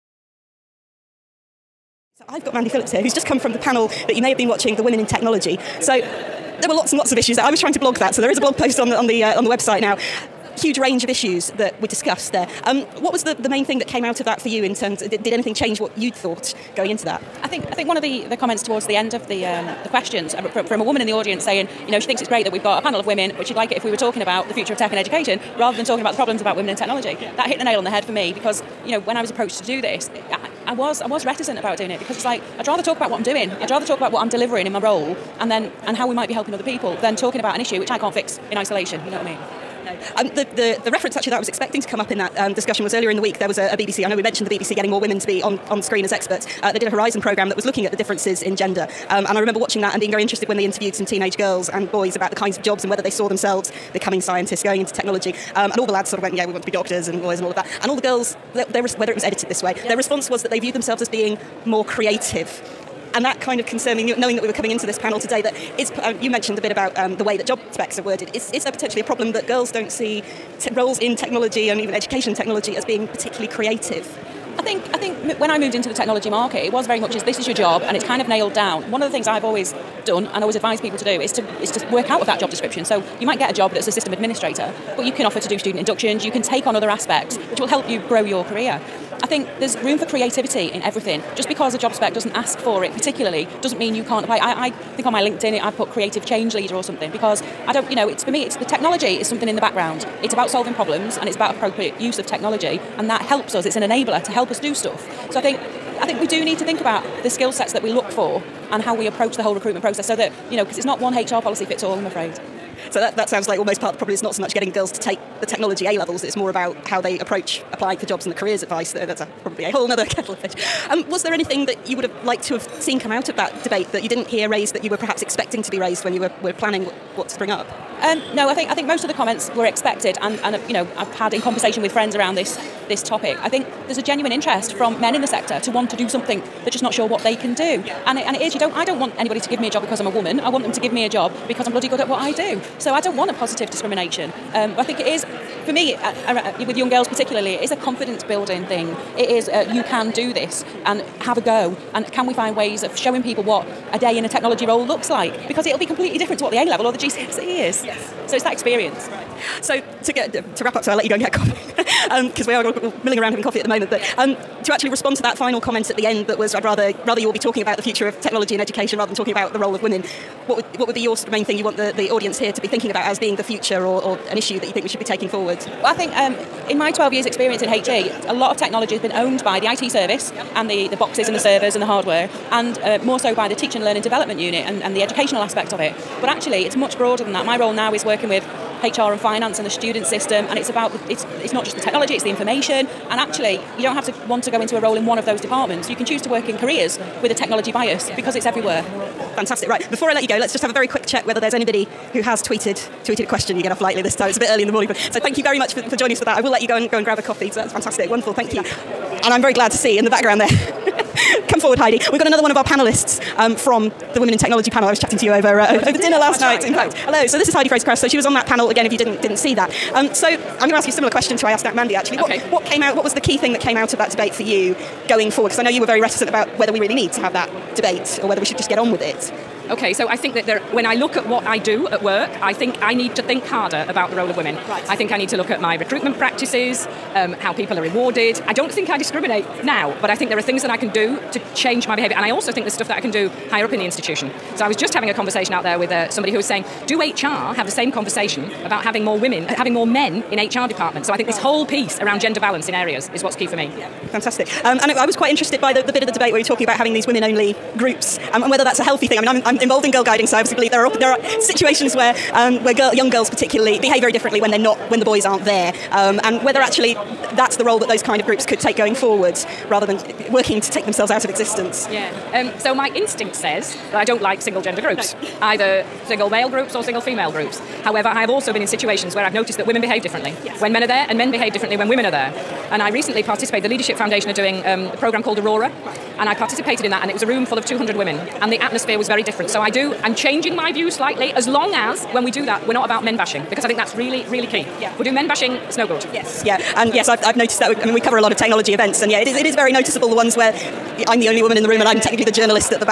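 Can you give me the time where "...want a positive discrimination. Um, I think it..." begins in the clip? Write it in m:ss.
2:23.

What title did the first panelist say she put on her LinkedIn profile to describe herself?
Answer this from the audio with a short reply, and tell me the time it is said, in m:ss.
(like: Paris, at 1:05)
creative change leader, at 1:35.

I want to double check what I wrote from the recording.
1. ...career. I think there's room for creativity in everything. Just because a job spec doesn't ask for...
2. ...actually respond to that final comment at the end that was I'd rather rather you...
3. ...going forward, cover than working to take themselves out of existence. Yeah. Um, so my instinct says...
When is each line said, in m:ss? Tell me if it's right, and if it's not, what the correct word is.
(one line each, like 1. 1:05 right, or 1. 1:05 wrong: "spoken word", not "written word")
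1. 1:28 right
2. 2:44 right
3. 4:28 wrong: "rather", not "cover".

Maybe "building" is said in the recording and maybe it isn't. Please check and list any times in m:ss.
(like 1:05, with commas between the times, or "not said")
2:28.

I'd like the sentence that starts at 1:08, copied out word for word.
Is, is there potentially a problem that girls don't see roles in technology and even education technology as being particularly creative?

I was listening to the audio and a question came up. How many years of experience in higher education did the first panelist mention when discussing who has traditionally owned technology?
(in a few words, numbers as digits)
12.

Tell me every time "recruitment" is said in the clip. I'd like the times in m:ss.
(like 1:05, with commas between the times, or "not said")
1:49, 3:55.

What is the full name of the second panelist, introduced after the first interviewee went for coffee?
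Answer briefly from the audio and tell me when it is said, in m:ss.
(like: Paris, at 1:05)
Heidi Fraser-Krauss, at 3:37.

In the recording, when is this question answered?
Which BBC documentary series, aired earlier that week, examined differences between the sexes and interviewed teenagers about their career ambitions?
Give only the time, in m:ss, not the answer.
0:46.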